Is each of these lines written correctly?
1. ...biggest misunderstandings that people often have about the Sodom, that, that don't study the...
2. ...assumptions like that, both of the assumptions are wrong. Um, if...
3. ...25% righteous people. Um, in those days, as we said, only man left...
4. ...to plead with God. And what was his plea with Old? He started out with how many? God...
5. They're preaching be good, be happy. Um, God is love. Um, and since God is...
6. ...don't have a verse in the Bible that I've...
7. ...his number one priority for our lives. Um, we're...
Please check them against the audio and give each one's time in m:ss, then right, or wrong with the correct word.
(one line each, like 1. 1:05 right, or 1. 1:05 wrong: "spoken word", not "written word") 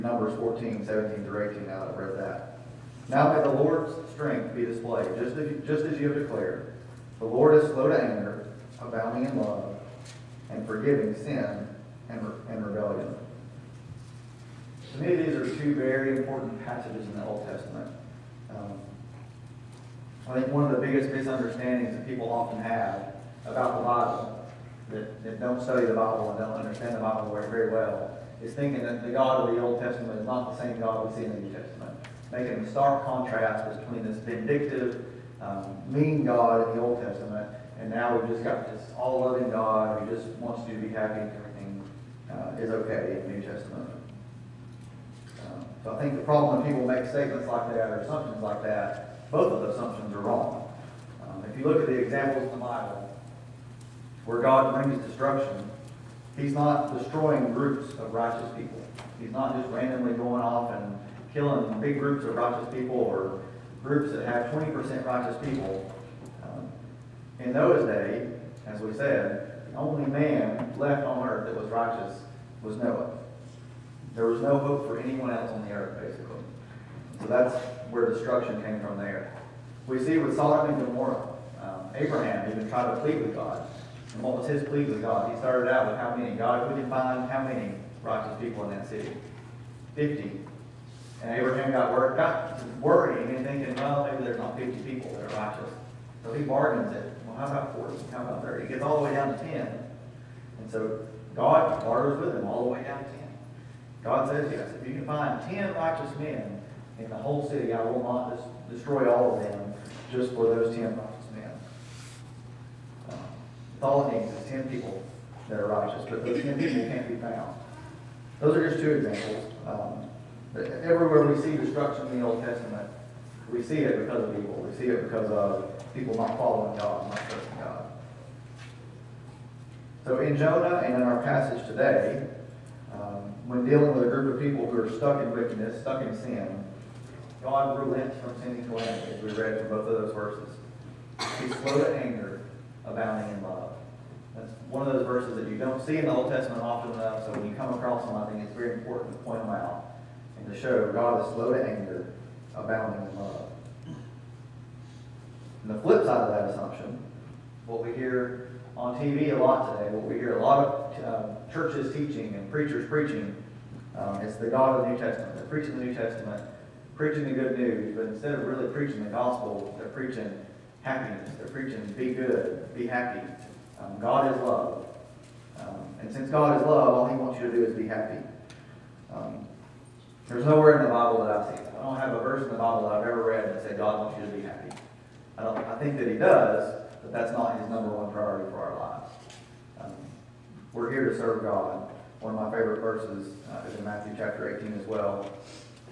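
1. 0:20 wrong: "Bible", not "Sodom"
2. 0:48 right
3. 1:04 wrong: "20", not "25"
4. 1:22 wrong: "God", not "Old"
5. 2:51 right
6. 3:01 right
7. 3:07 right.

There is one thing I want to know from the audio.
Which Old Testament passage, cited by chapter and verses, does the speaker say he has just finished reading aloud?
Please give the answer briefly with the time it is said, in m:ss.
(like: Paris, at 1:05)
Numbers 14:17-18, at 0:00.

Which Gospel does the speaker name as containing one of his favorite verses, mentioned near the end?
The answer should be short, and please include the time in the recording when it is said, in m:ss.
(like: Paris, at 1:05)
Matthew, at 3:13.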